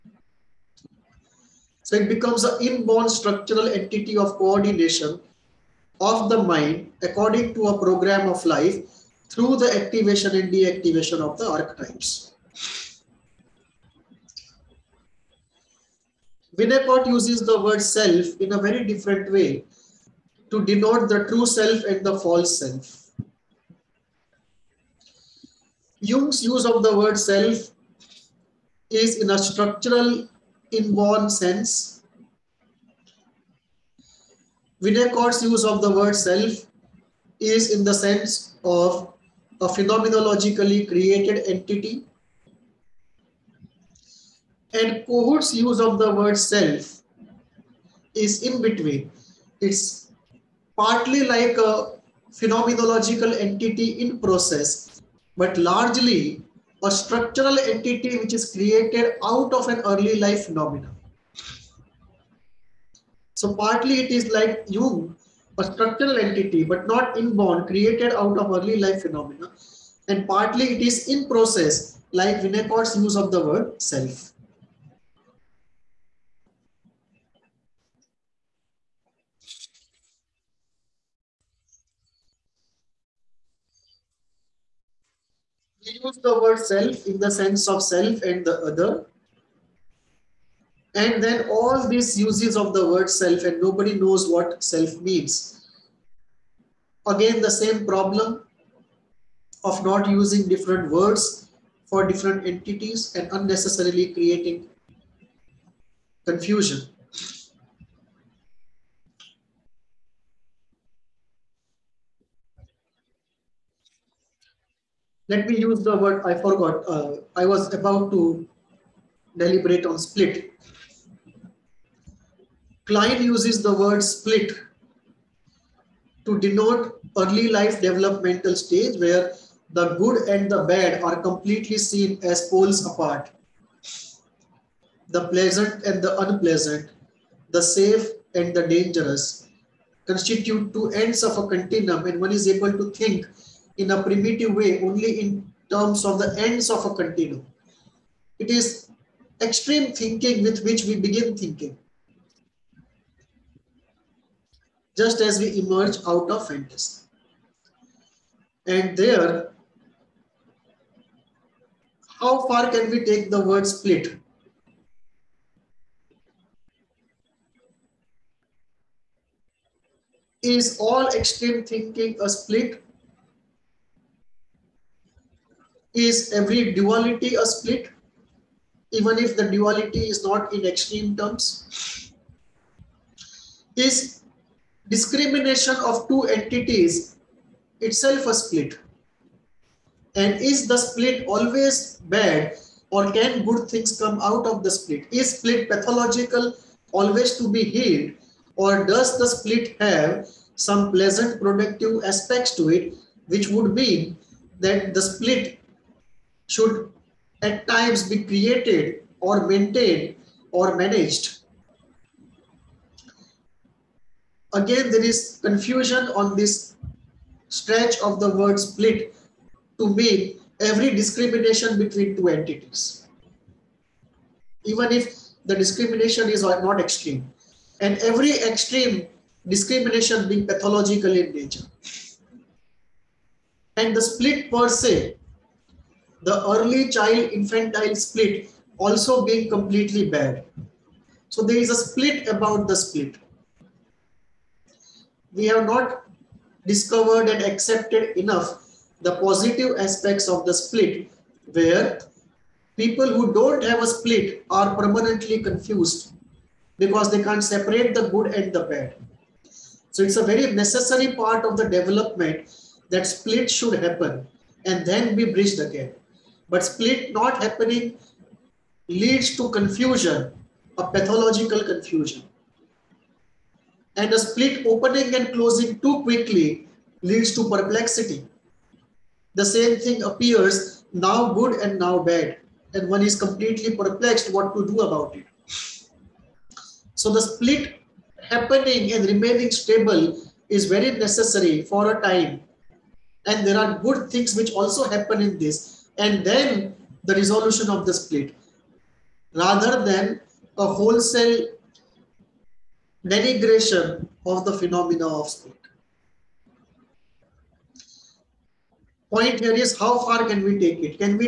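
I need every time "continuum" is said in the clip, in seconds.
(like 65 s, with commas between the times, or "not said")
141 s, 146 s.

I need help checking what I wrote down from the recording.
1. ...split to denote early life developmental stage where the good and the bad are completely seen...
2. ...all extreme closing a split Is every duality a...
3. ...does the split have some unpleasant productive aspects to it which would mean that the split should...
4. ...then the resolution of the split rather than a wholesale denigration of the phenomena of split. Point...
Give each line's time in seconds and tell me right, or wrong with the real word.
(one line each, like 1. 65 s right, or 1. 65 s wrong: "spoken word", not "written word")
1. 124 s right
2. 170 s wrong: "thinking", not "closing"
3. 198 s wrong: "pleasant", not "unpleasant"
4. 296 s right.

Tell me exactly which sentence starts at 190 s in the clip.
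And is the split always bad or can good things come out of the split?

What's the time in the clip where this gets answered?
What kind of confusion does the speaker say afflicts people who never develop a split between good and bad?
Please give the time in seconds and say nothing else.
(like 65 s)
270 s.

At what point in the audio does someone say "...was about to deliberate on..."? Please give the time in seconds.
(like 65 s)
117 s.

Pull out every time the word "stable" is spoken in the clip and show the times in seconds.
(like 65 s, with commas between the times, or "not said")
289 s.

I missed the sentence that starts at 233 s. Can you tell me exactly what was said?
And the split per se the early child infantile split also being completely bad.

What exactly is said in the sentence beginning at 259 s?
So it's a very necessary part of the development that split should happen and then we bridge the gap.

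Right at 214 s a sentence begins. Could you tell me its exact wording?
Again, there is confusion on this stretch of the word split to mean every discrimination between two entities.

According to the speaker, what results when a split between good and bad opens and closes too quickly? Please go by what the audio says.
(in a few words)
perplexity.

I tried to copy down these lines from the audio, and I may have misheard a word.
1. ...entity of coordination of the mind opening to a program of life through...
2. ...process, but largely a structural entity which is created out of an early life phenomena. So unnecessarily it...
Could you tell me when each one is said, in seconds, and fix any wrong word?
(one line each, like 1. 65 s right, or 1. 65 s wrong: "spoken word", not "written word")
1. 3 s wrong: "according", not "opening"
2. 54 s wrong: "partly", not "unnecessarily".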